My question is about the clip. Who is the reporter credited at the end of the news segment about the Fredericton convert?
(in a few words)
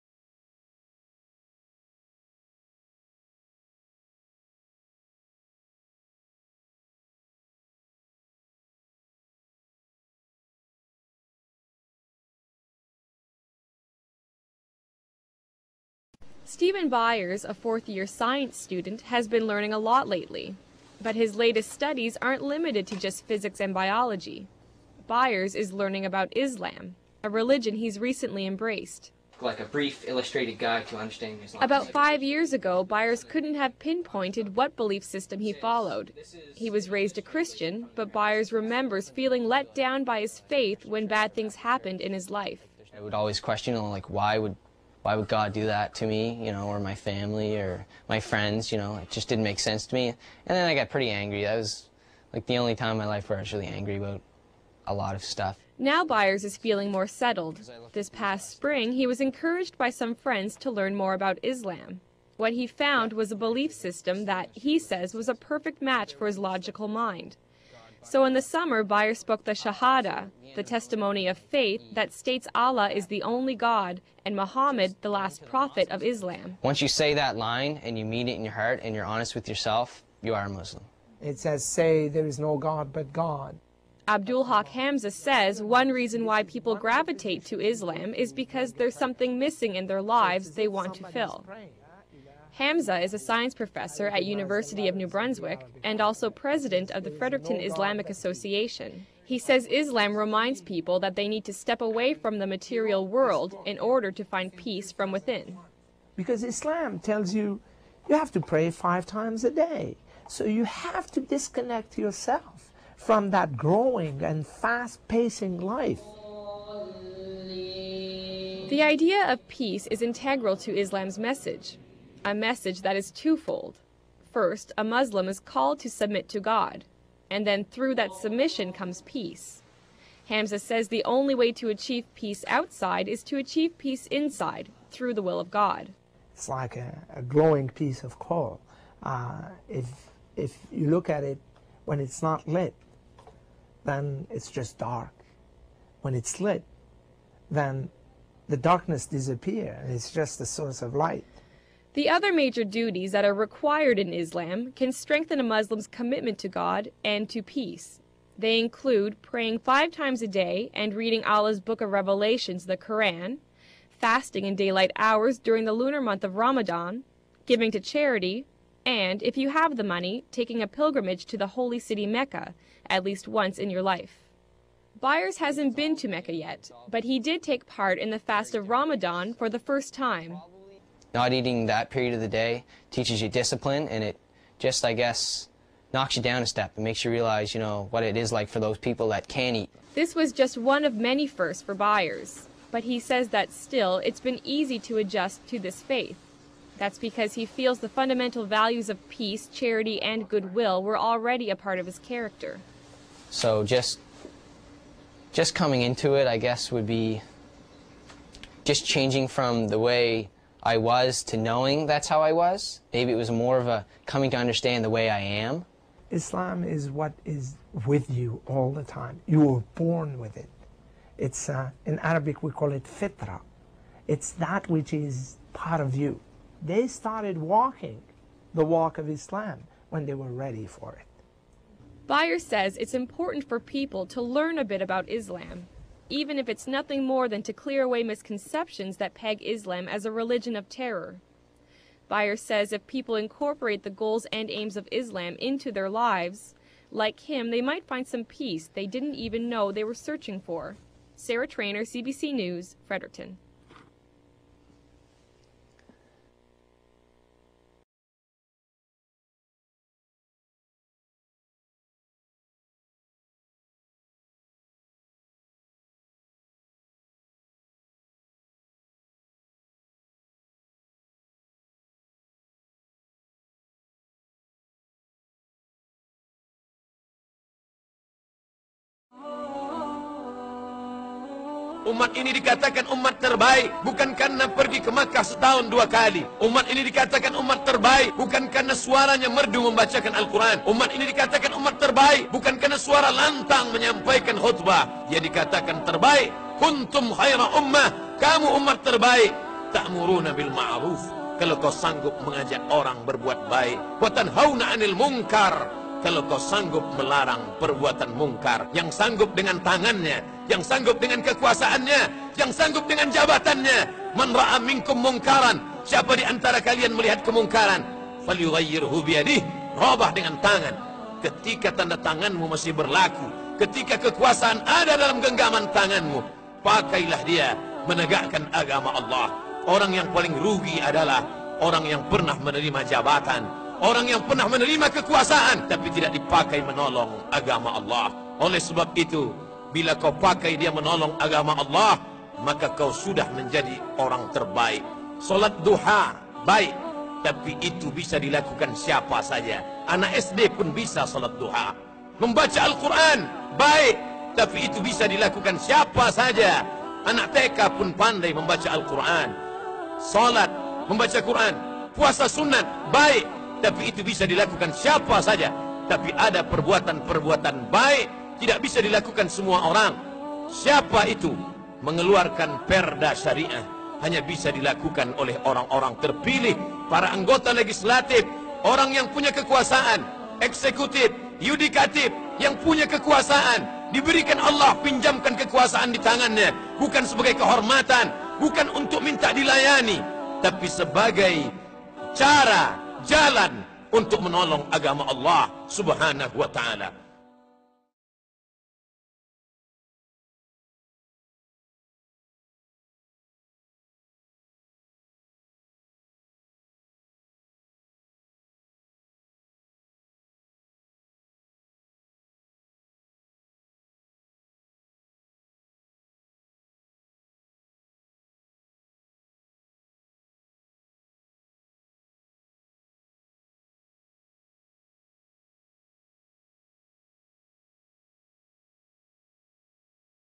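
Sarah Trainer.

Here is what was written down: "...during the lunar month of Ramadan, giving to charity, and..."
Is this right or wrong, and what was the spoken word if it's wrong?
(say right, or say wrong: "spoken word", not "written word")
right.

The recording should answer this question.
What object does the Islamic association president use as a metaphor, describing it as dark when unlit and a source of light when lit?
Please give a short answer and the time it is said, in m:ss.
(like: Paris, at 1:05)
glowing piece of coal, at 2:17.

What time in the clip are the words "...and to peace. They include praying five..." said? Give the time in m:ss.
2:37.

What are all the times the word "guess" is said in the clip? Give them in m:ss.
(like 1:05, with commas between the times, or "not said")
3:04, 3:26.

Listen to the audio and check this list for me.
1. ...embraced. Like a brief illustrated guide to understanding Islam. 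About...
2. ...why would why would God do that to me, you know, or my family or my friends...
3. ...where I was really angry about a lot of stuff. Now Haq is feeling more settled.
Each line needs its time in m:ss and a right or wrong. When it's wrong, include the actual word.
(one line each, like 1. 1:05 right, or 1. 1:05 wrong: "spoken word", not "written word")
1. 0:28 right
2. 0:44 right
3. 0:53 wrong: "Byers", not "Haq".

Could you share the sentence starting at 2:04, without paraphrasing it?
First, a Muslim is called to submit to God, and then through that submission comes peace.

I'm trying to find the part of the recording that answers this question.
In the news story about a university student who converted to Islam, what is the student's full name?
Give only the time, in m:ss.
0:16.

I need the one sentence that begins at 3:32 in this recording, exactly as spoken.
Maybe it was more of a coming to understand the way I am.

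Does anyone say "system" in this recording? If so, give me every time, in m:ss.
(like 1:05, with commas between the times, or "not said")
0:35, 1:03.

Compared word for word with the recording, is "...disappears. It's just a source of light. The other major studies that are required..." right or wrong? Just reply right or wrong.
wrong.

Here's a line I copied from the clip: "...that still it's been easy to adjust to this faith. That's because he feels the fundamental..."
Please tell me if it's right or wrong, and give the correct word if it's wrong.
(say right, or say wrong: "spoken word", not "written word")
right.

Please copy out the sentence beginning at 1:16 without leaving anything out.
Once you say that line and you mean it in your heart and you're honest with yourself, you are a Muslim.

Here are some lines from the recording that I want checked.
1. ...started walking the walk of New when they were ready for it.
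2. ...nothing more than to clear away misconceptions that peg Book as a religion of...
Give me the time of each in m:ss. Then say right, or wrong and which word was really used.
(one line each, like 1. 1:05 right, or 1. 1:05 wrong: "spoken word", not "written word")
1. 3:46 wrong: "Islam", not "New"
2. 3:56 wrong: "Islam", not "Book".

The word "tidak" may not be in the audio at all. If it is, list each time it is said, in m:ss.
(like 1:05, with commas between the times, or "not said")
5:35, 6:08.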